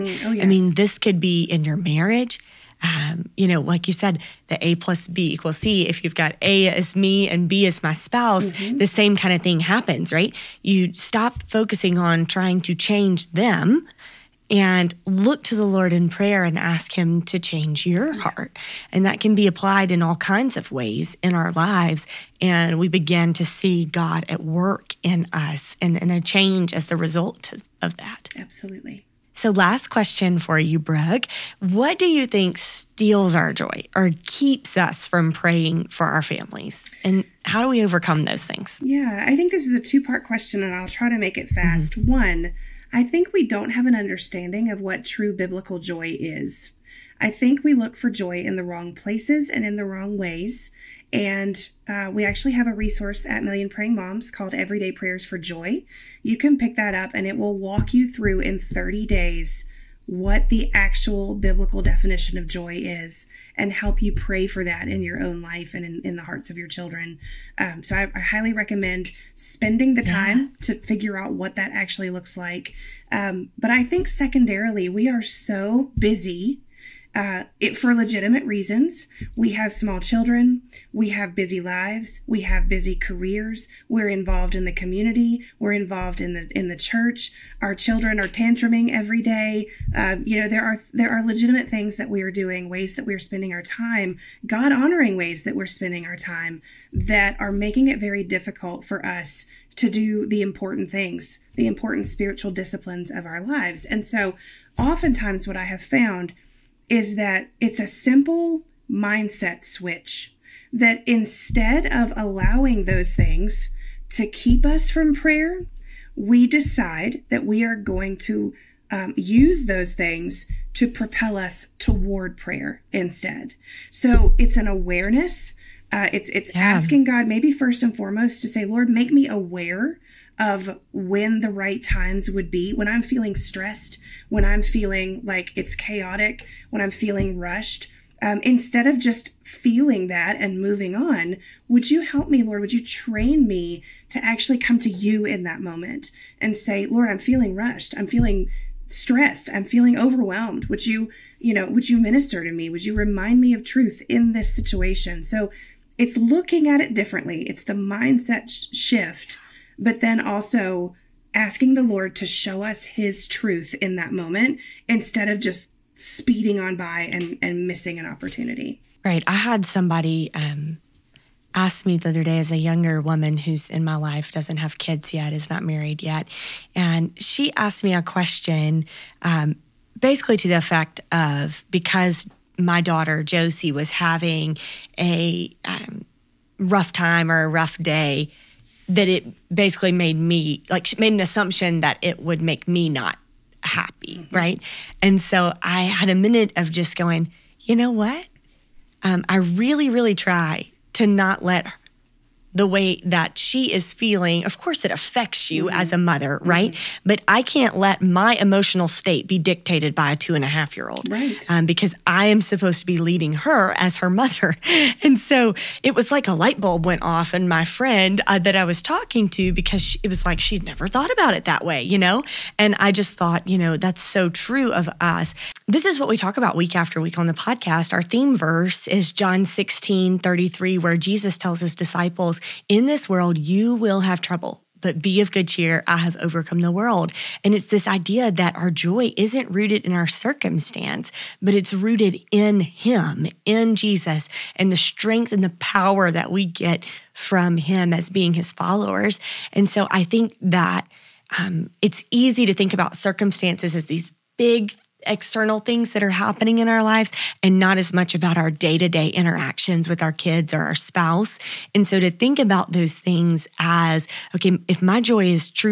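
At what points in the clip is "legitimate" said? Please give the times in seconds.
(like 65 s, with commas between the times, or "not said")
77 s, 91 s.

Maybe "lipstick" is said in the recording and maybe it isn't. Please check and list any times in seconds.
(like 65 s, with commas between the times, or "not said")
not said.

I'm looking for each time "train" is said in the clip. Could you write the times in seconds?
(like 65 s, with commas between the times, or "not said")
142 s.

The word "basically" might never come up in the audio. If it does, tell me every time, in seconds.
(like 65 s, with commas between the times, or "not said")
179 s, 189 s.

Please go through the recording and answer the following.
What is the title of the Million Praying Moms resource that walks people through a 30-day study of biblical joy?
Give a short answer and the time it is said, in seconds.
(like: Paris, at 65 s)
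Everyday Prayers for Joy, at 54 s.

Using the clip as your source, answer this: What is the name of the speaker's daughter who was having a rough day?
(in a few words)
Josie.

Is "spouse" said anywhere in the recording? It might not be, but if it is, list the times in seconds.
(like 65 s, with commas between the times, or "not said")
7 s, 260 s.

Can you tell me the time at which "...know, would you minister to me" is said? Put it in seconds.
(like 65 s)
151 s.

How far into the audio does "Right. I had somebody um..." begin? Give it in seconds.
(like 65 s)
169 s.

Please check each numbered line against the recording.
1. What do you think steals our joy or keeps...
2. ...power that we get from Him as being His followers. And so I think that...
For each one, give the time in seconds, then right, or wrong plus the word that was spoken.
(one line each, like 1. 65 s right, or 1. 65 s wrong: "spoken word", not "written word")
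1. 31 s right
2. 245 s right.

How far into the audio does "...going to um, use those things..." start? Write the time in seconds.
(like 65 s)
117 s.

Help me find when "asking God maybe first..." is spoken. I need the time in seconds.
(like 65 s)
126 s.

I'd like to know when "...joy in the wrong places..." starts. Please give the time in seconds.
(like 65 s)
48 s.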